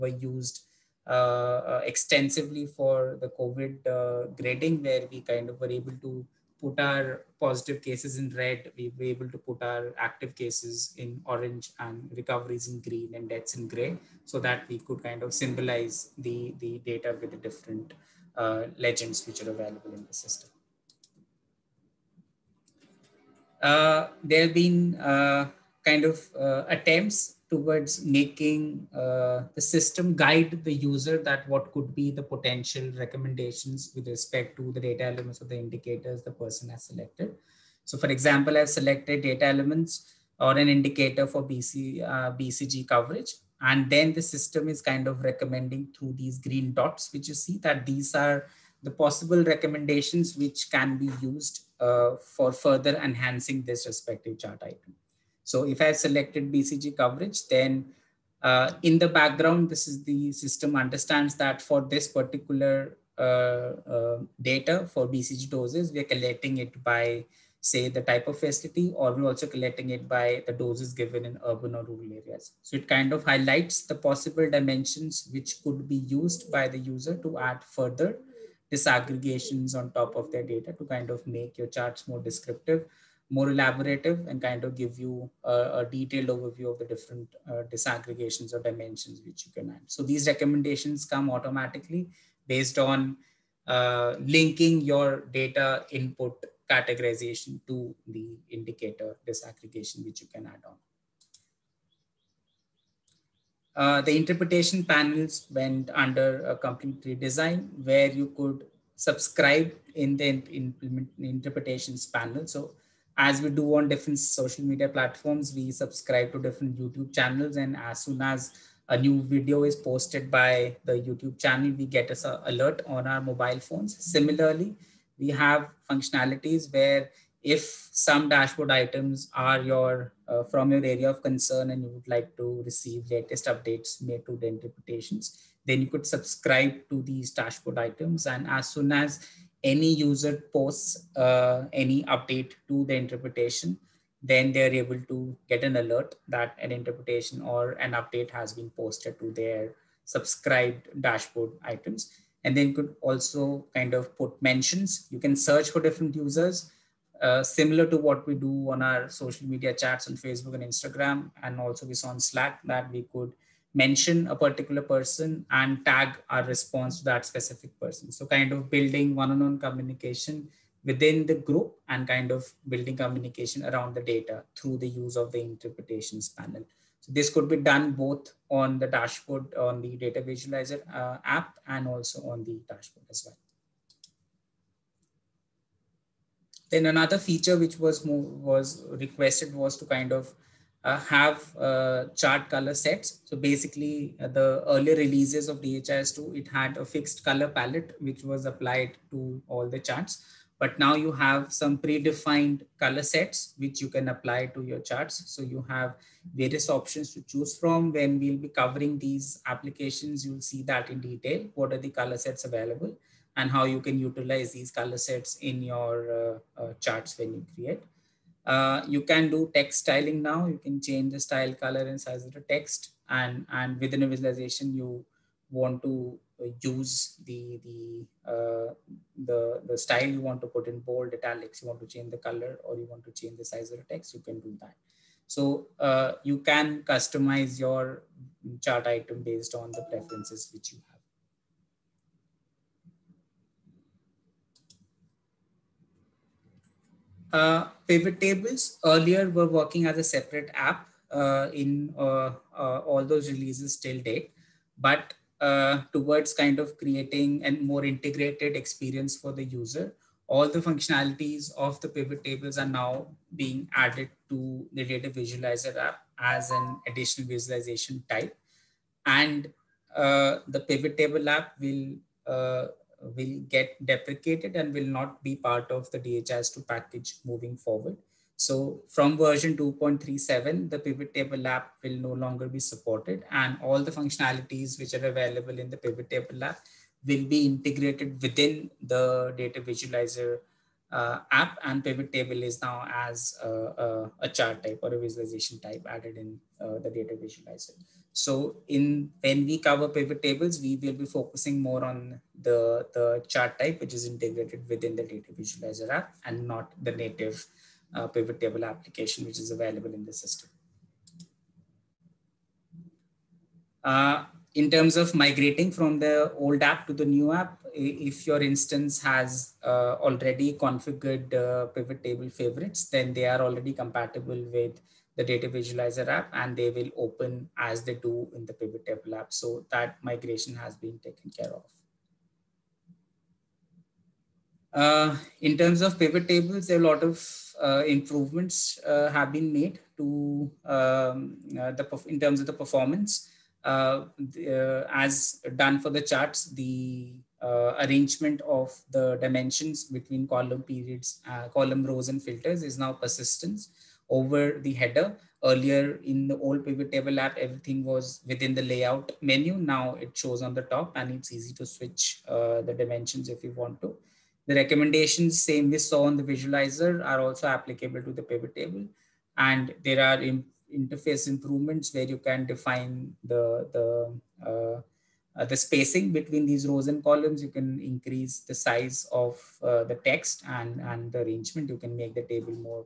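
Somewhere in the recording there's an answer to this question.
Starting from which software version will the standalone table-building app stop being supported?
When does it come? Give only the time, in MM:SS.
04:39.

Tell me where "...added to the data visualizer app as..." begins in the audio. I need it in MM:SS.
04:23.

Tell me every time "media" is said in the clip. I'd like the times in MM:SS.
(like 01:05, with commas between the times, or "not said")
01:54, 02:39.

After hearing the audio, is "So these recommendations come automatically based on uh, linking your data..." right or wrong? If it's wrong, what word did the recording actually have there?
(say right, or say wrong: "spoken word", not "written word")
right.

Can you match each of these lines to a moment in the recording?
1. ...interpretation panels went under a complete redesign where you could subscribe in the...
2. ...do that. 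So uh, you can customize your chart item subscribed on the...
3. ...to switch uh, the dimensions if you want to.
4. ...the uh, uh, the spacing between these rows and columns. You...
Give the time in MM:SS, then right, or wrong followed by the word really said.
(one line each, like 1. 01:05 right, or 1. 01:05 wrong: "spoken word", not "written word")
1. 01:44 right
2. 03:54 wrong: "based", not "subscribed"
3. 06:01 right
4. 06:13 right.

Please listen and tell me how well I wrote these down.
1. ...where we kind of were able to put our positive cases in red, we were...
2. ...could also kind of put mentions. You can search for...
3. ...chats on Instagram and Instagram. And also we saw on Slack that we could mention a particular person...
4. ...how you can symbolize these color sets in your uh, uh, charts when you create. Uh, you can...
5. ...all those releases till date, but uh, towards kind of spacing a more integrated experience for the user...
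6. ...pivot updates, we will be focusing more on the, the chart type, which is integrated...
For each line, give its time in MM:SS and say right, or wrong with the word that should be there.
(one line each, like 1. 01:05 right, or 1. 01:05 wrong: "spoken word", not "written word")
1. 00:04 right
2. 02:32 right
3. 02:39 wrong: "Facebook", not "Instagram"
4. 03:33 wrong: "utilize", not "symbolize"
5. 04:12 wrong: "creating", not "spacing"
6. 04:59 wrong: "tables", not "updates".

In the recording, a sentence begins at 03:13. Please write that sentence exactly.
So basically uh, the early releases of DHIS2, it had a fixed color palette, which was applied to all the charts.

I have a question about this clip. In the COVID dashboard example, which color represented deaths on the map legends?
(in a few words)
gray.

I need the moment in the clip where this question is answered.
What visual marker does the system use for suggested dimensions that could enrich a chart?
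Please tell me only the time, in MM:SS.
00:46.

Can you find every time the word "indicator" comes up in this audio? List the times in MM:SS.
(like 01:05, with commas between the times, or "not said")
00:35, 00:40, 01:38.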